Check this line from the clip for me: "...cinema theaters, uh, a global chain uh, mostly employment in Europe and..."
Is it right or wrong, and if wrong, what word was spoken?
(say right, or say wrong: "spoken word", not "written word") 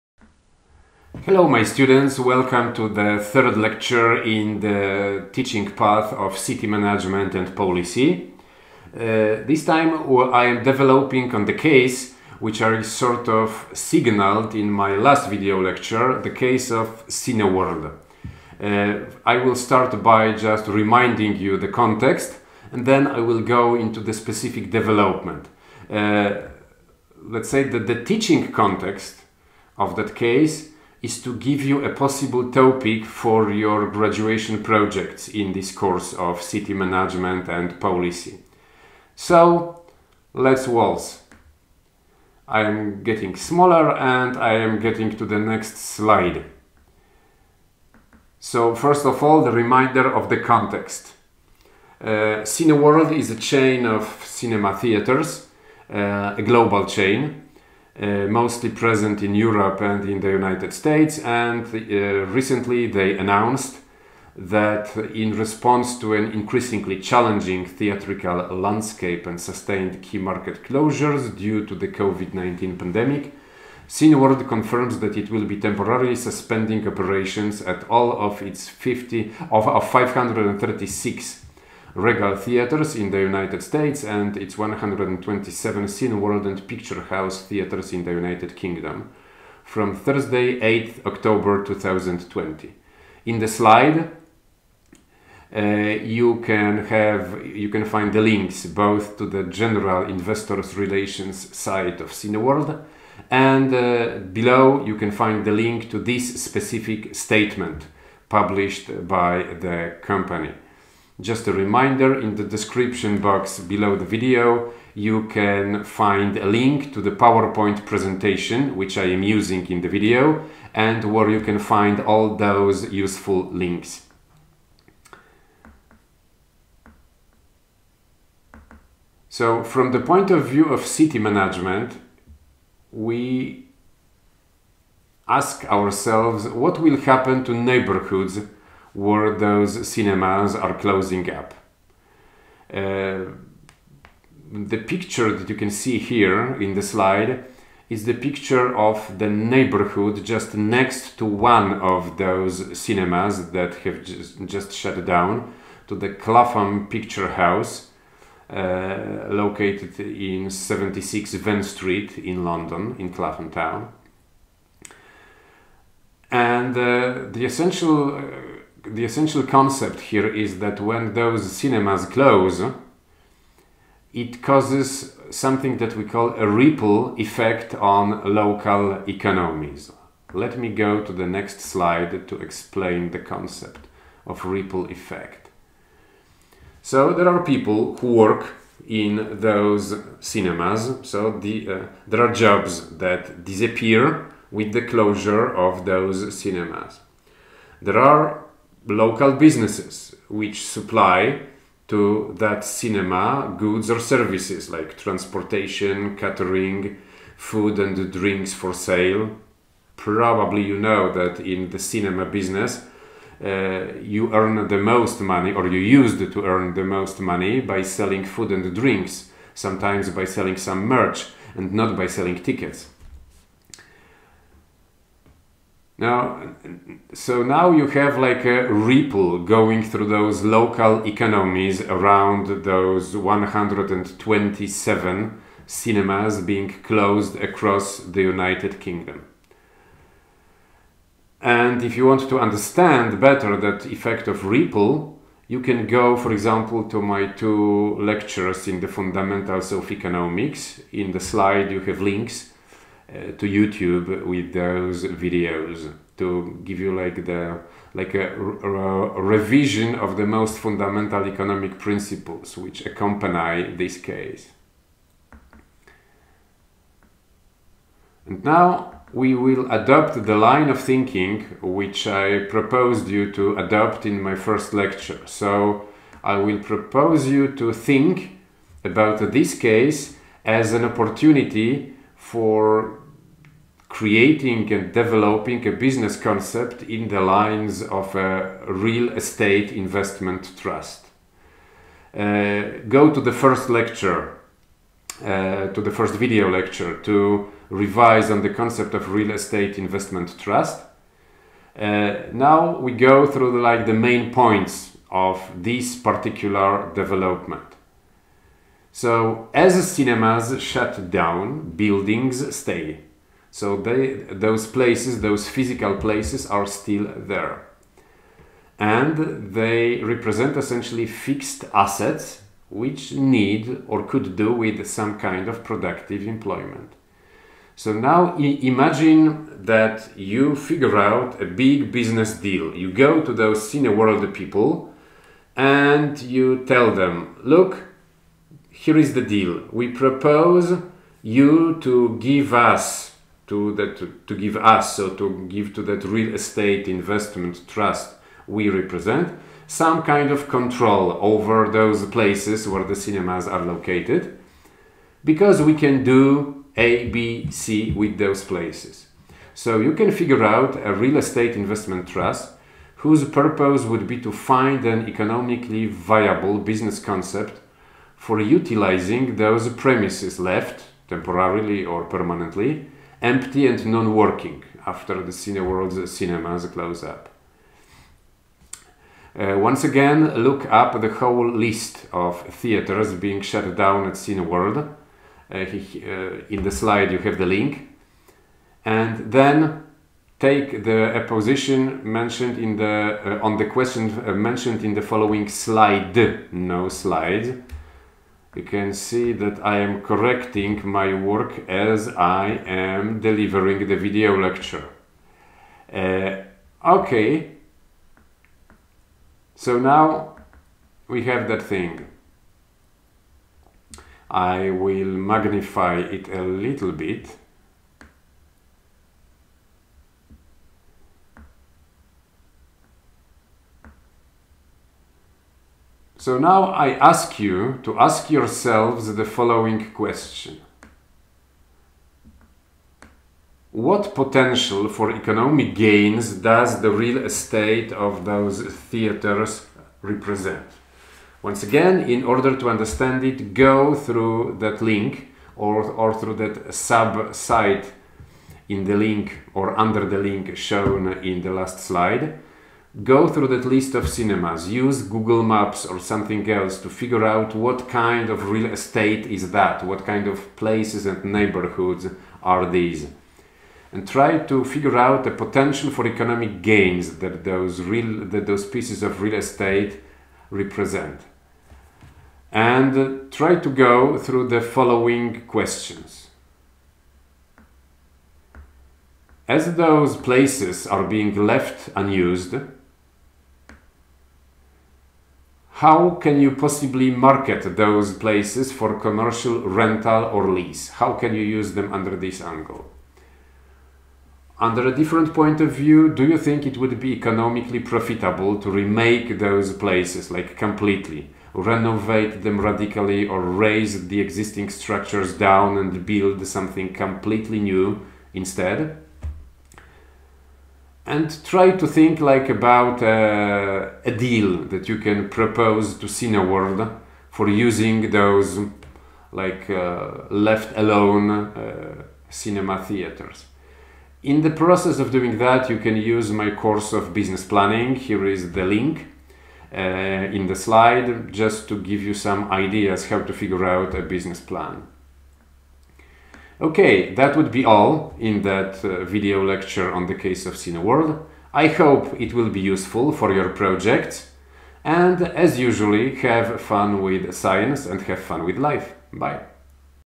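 wrong: "present", not "employment".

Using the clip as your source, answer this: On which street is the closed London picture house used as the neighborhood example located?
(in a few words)
Venn Street.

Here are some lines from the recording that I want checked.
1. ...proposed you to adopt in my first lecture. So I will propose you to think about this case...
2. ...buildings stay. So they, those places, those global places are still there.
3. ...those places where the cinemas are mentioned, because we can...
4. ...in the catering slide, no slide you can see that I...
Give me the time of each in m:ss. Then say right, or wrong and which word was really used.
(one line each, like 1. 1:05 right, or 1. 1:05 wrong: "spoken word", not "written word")
1. 4:32 right
2. 5:11 wrong: "physical", not "global"
3. 5:51 wrong: "located", not "mentioned"
4. 6:34 wrong: "following", not "catering".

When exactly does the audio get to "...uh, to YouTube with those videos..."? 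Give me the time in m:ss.
4:13.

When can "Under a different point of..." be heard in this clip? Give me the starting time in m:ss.
8:14.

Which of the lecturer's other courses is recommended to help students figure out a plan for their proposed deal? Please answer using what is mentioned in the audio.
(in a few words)
Business planning.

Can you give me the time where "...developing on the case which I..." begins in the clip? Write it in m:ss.
0:10.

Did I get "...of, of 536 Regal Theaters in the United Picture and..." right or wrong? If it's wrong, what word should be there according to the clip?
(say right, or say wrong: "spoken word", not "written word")
wrong: "States", not "Picture".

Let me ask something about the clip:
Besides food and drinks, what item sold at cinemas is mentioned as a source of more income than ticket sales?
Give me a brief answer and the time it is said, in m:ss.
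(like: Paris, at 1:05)
Merch, at 3:40.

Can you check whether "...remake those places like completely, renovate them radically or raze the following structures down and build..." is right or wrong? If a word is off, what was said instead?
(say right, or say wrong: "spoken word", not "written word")
wrong: "existing", not "following".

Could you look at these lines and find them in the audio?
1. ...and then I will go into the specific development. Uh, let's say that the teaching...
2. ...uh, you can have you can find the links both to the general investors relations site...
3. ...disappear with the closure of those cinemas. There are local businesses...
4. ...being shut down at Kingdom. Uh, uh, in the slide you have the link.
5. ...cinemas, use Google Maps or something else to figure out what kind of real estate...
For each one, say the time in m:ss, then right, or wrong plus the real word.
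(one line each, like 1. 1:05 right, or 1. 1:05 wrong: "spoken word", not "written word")
1. 0:22 right
2. 1:35 right
3. 3:13 right
4. 6:23 wrong: "Cineworld", not "Kingdom"
5. 7:34 right.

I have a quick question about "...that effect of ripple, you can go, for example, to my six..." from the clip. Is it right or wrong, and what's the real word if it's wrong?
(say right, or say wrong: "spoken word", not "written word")
wrong: "two", not "six".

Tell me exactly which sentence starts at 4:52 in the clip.
Uh, go to the first lecture, uh, to the first video lecture to revise on the concept of real estate investment trust.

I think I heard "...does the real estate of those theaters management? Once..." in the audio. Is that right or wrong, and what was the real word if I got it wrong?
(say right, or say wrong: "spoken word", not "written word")
wrong: "represent", not "management".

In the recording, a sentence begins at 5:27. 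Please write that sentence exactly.
So now imagine that you figure out a big business deal.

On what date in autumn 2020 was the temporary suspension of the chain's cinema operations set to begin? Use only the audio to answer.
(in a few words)
8 October 2020.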